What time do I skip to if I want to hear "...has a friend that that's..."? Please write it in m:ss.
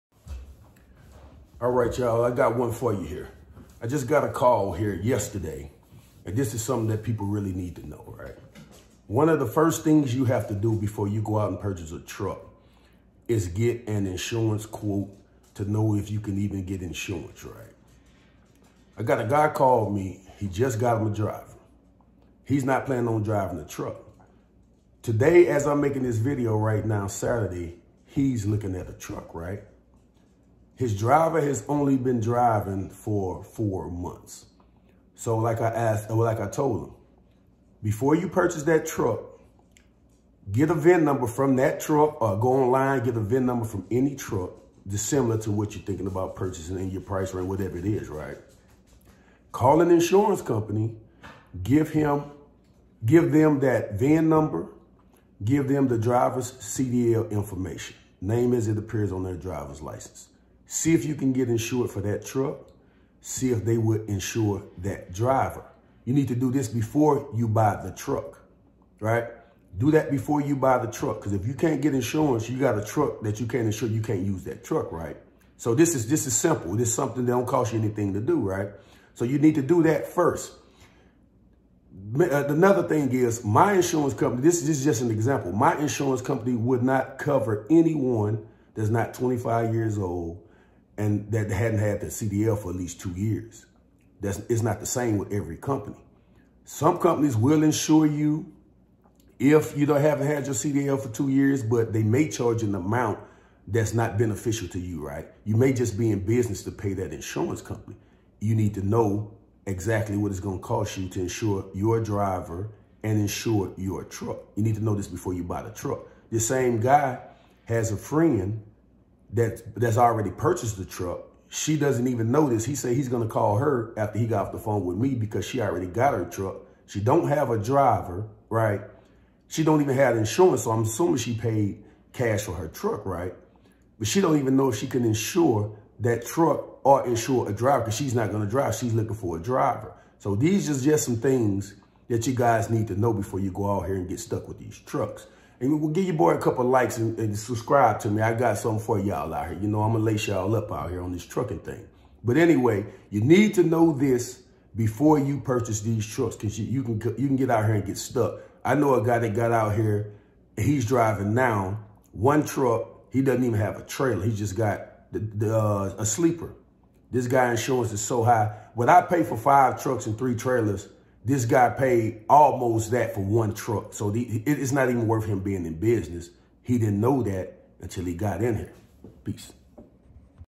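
1:57.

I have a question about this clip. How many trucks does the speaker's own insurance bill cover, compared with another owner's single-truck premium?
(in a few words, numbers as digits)
5.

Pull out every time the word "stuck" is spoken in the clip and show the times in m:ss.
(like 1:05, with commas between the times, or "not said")
2:24, 2:37.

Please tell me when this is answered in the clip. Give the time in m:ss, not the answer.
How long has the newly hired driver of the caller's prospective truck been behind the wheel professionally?
0:33.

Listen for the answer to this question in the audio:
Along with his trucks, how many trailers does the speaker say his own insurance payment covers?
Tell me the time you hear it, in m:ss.
2:50.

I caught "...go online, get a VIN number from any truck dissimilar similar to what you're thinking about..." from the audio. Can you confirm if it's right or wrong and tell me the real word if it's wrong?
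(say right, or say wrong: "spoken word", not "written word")
right.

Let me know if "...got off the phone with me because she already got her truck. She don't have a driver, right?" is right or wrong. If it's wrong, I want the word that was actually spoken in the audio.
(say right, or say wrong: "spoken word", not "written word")
right.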